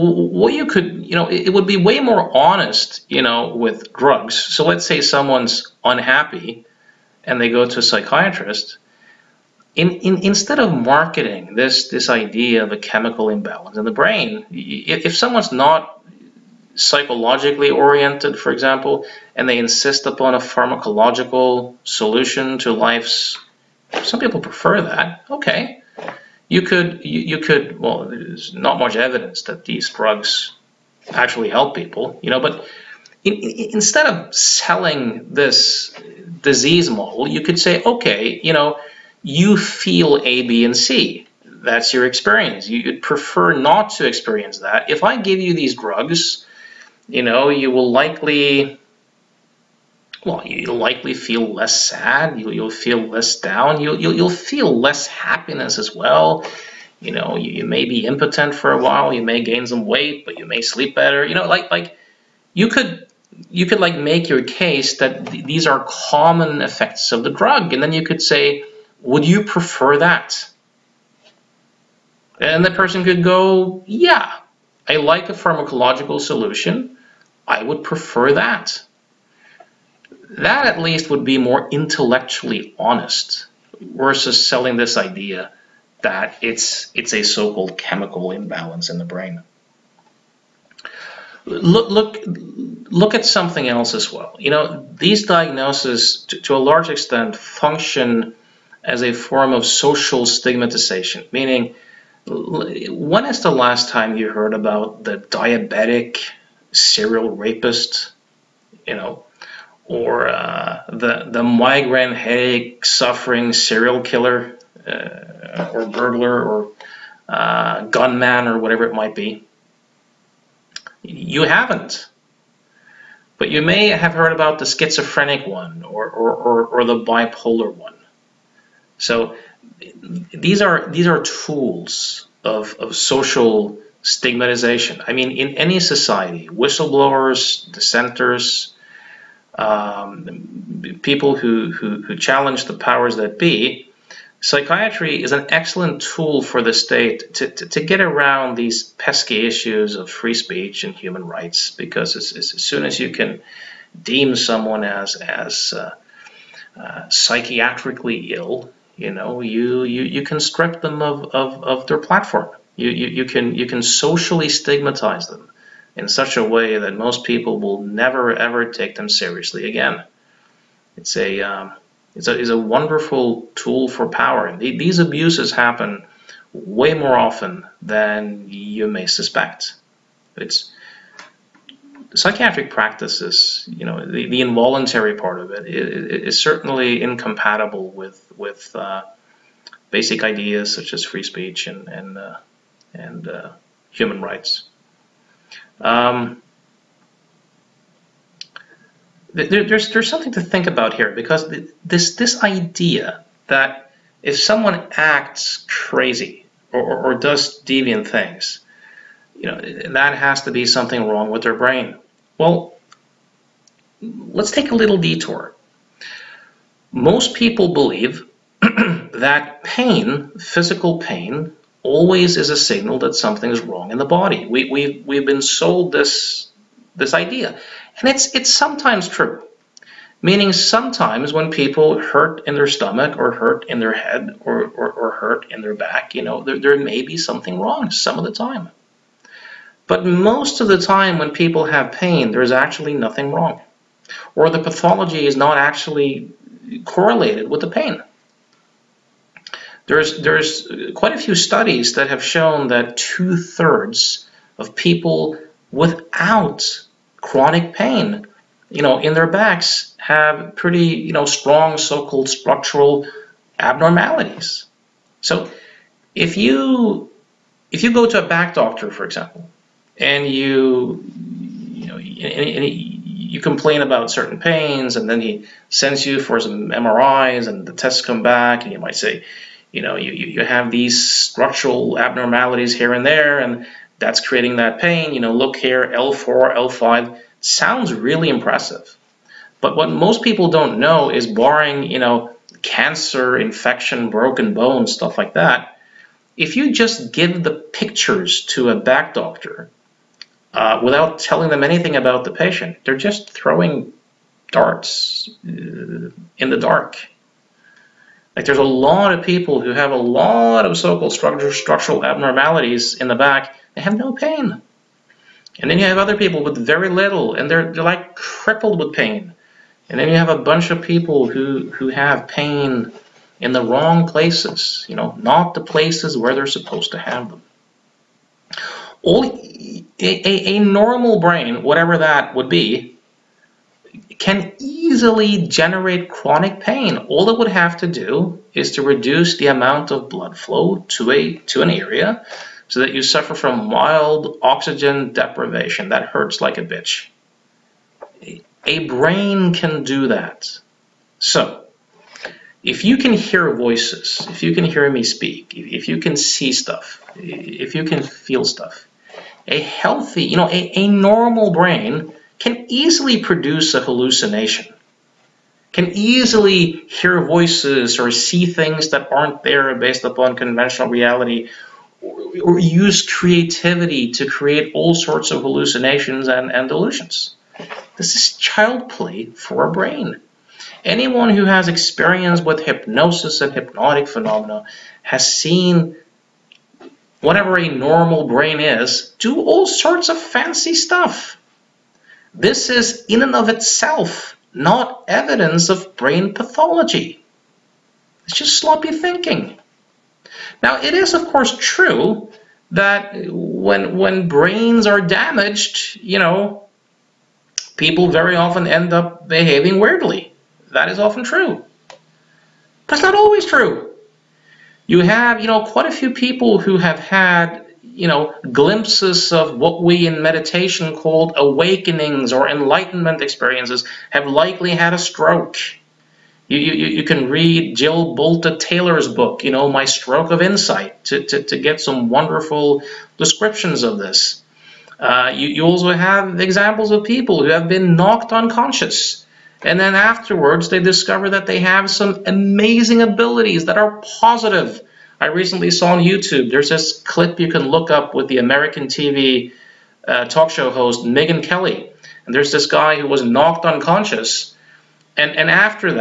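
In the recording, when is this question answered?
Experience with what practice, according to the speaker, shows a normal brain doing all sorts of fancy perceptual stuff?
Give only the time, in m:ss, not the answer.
6:22.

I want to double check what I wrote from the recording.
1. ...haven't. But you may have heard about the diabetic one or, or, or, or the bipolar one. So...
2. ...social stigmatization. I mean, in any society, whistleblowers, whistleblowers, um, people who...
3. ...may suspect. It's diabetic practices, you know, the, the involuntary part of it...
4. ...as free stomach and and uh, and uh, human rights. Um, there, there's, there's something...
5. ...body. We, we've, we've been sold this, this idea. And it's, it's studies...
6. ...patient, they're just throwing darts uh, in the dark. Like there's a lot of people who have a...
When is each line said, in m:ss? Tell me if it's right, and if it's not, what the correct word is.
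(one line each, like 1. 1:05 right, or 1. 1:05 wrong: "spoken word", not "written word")
1. 2:01 wrong: "schizophrenic", not "diabetic"
2. 2:12 wrong: "dissenters", not "whistleblowers"
3. 2:58 wrong: "psychiatric", not "diabetic"
4. 3:10 wrong: "speech", not "stomach"
5. 3:44 wrong: "sometimes", not "studies"
6. 5:02 right.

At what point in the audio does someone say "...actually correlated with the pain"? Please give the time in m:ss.
4:05.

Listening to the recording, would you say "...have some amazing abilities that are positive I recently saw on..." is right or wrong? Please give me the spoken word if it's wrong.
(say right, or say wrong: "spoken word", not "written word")
right.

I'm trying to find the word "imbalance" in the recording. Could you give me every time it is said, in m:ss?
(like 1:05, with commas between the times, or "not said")
0:13, 1:28.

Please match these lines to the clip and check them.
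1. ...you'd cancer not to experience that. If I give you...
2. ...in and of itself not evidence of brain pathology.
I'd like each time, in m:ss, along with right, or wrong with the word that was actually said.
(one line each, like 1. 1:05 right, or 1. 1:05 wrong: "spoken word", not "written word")
1. 0:42 wrong: "prefer", not "cancer"
2. 6:33 right.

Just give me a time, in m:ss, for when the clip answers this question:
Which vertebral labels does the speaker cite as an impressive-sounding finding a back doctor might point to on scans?
4:45.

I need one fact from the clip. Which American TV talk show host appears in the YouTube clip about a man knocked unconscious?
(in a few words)
Megyn Kelly.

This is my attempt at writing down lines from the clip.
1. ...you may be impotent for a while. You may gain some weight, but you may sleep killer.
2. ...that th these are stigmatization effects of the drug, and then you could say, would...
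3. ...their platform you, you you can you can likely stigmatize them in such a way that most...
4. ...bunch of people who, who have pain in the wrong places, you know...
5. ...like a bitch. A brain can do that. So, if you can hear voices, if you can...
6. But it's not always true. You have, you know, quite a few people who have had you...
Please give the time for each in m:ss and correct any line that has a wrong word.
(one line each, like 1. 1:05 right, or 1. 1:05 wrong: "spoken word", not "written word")
1. 0:57 wrong: "better", not "killer"
2. 1:04 wrong: "common", not "stigmatization"
3. 2:41 wrong: "socially", not "likely"
4. 5:20 right
5. 5:46 right
6. 6:52 right.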